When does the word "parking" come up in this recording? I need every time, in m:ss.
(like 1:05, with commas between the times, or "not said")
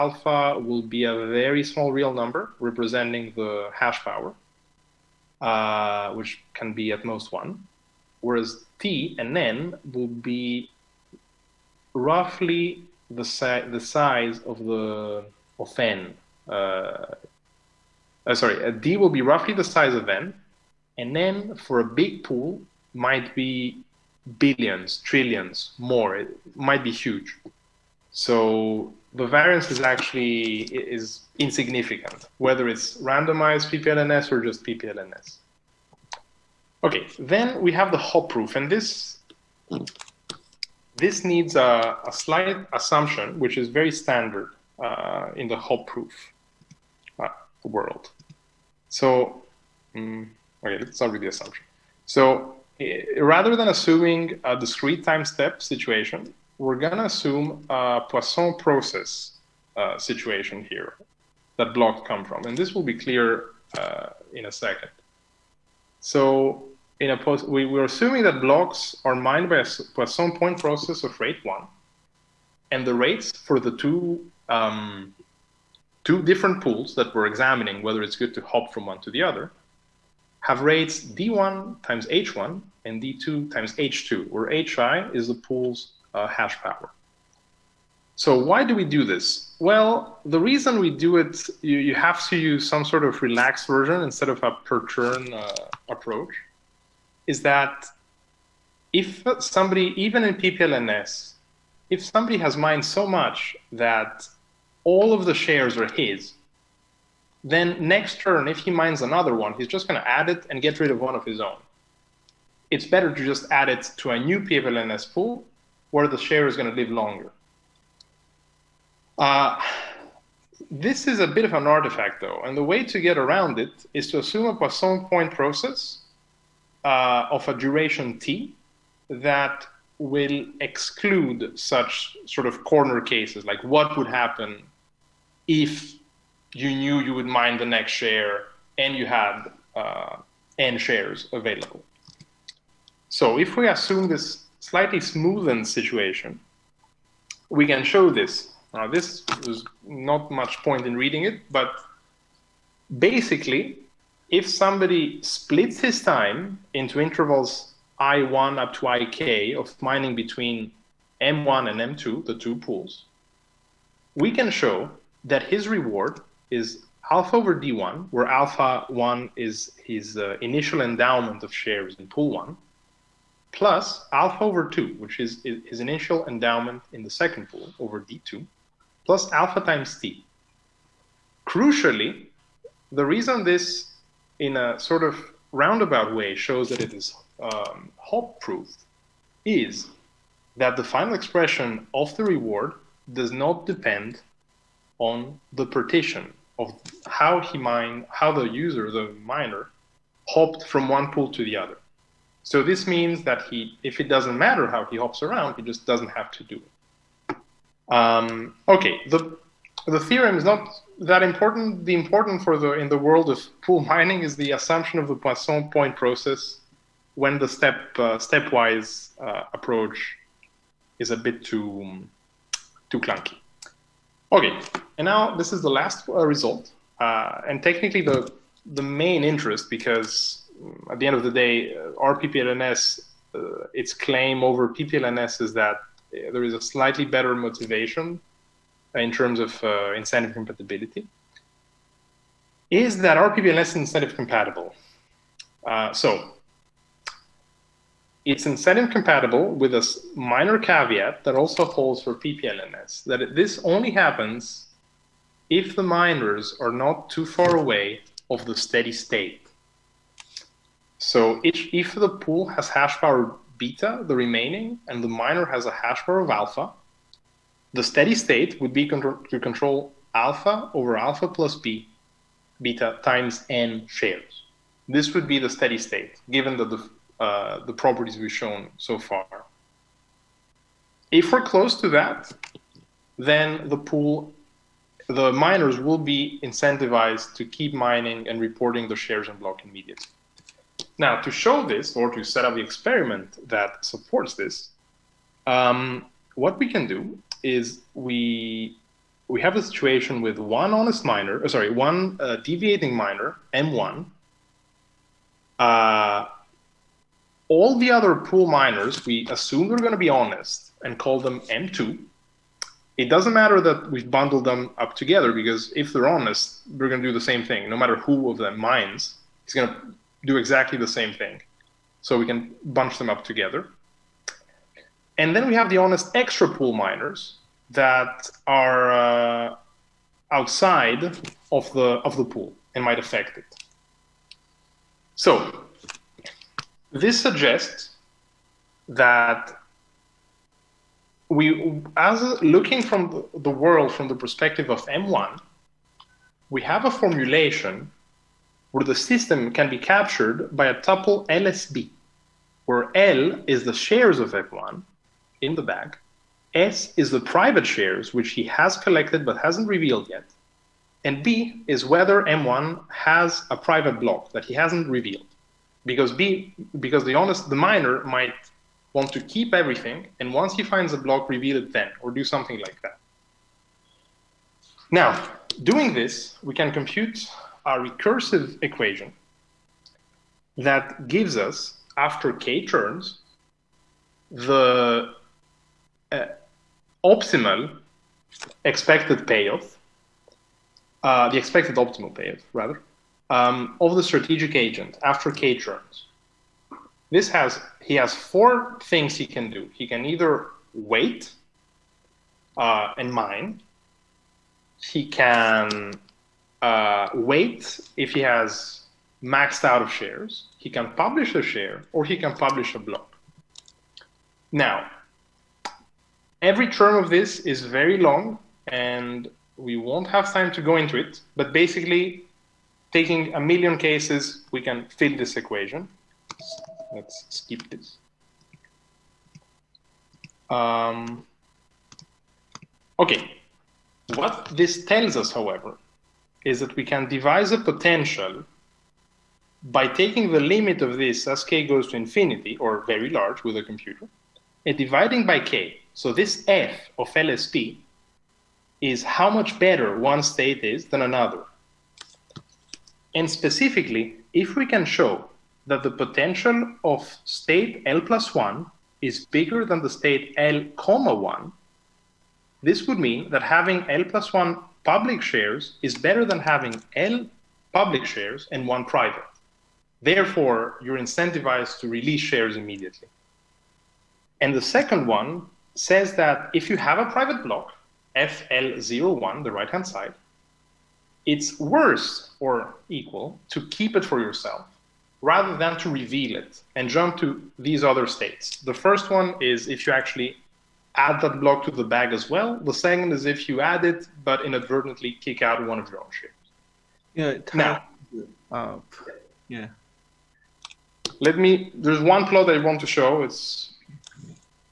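not said.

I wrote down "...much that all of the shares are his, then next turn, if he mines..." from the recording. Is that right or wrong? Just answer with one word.
right.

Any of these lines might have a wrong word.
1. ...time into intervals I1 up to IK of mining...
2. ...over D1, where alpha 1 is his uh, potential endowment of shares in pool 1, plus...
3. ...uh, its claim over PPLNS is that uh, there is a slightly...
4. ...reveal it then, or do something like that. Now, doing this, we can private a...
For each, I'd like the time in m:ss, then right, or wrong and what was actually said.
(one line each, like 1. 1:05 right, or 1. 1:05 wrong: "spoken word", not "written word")
1. 2:36 right
2. 2:47 wrong: "initial", not "potential"
3. 3:53 right
4. 6:11 wrong: "compute", not "private".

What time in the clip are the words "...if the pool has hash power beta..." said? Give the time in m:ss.
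4:21.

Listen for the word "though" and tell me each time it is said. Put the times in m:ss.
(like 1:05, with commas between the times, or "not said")
2:02.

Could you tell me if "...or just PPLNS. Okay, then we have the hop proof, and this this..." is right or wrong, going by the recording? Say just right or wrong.
right.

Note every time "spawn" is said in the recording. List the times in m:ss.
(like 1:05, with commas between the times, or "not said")
not said.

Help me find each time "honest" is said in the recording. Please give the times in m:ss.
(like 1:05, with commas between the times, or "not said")
5:00, 5:10, 5:16, 5:25, 6:07.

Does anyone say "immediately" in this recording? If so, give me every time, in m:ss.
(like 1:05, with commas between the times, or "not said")
4:49, 7:52.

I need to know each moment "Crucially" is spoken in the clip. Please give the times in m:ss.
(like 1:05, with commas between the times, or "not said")
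3:01.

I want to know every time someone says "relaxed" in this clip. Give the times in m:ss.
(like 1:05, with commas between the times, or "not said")
1:33.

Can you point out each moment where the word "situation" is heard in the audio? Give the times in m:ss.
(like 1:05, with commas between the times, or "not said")
0:55, 0:59, 2:25, 4:59.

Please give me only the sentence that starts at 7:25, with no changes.
So this f of LSP is how much better one state is than another.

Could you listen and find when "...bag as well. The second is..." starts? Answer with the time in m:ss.
8:11.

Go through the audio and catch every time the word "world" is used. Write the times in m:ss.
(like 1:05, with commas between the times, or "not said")
0:47, 3:32, 5:43.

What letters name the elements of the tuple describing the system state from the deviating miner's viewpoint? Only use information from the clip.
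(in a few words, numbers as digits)
LSB.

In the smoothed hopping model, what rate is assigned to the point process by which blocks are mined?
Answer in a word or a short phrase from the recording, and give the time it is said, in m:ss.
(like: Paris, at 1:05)
1, at 1:11.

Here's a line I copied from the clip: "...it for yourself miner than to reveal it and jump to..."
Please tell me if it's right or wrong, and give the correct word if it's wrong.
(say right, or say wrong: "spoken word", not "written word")
wrong: "rather", not "miner".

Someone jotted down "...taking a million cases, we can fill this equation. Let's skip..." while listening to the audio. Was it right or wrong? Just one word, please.
right.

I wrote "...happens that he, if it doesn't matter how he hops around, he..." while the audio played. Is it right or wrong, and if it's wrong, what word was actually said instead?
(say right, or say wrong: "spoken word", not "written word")
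wrong: "means", not "happens".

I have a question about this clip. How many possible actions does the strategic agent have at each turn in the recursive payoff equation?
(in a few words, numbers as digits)
4.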